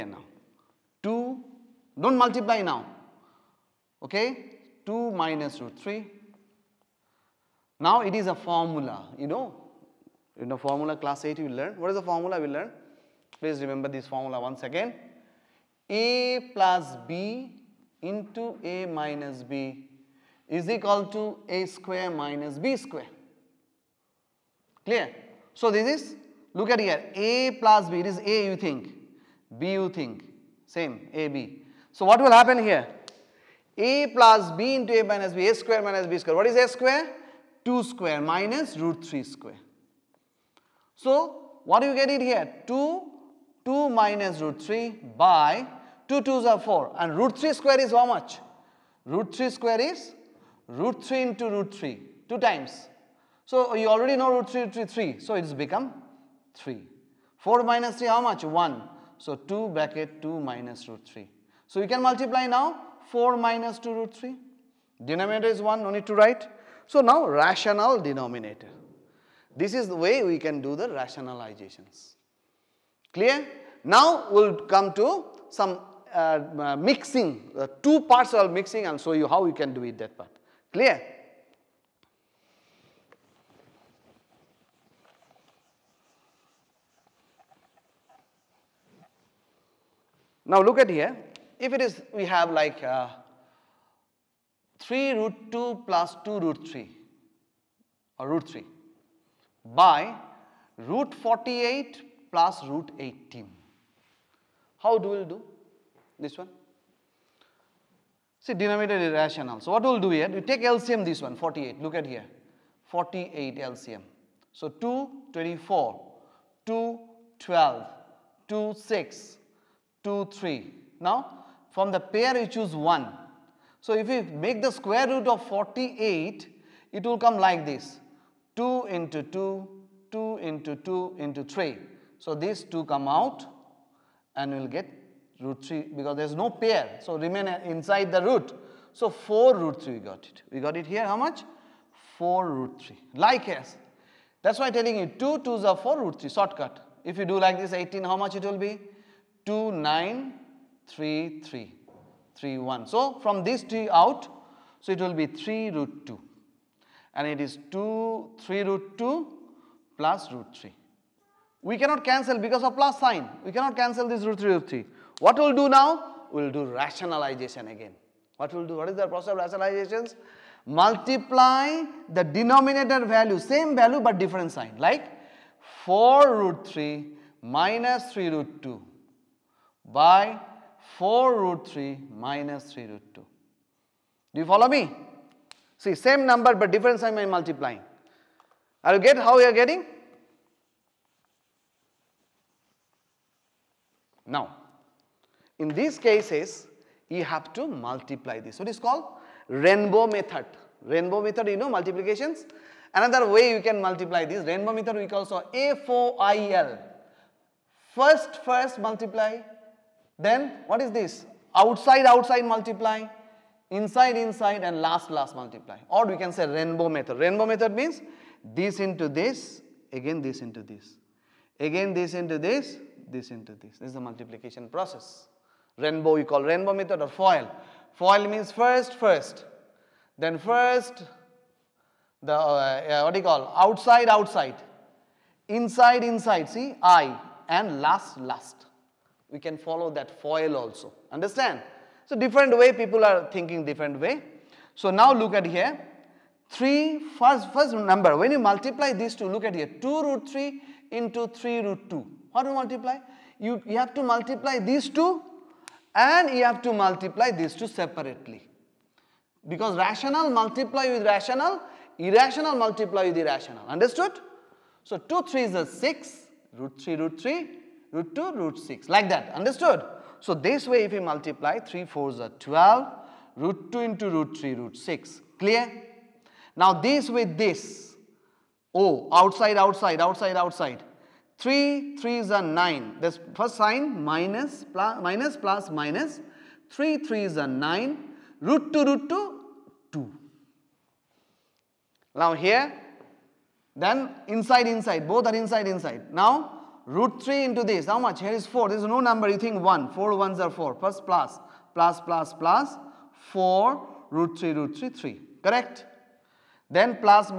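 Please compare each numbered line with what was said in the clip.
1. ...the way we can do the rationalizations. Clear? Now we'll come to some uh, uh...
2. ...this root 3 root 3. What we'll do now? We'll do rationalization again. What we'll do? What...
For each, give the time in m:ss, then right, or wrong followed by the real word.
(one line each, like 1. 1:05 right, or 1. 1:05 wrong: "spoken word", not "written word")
1. 1:09 right
2. 2:44 right.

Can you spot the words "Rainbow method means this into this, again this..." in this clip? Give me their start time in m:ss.
3:37.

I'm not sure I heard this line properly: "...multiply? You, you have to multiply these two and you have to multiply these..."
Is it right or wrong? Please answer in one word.
right.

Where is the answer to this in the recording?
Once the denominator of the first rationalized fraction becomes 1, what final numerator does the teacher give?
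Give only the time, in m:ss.
1:03.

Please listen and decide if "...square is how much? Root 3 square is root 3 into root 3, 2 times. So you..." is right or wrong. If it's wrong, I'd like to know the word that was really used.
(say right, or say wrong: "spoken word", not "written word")
right.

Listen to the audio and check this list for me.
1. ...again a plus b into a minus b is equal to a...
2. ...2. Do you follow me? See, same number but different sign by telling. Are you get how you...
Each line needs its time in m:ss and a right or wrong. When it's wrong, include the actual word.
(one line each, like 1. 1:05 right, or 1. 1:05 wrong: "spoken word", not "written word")
1. 0:14 right
2. 3:03 wrong: "multiplying", not "telling".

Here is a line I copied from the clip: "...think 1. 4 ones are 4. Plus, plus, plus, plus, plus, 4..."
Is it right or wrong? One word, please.
right.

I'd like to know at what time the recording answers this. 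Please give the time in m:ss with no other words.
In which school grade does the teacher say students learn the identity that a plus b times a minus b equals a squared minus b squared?
0:10.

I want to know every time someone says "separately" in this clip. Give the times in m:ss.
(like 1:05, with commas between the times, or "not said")
4:17.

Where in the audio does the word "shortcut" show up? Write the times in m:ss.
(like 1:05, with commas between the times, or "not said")
2:26.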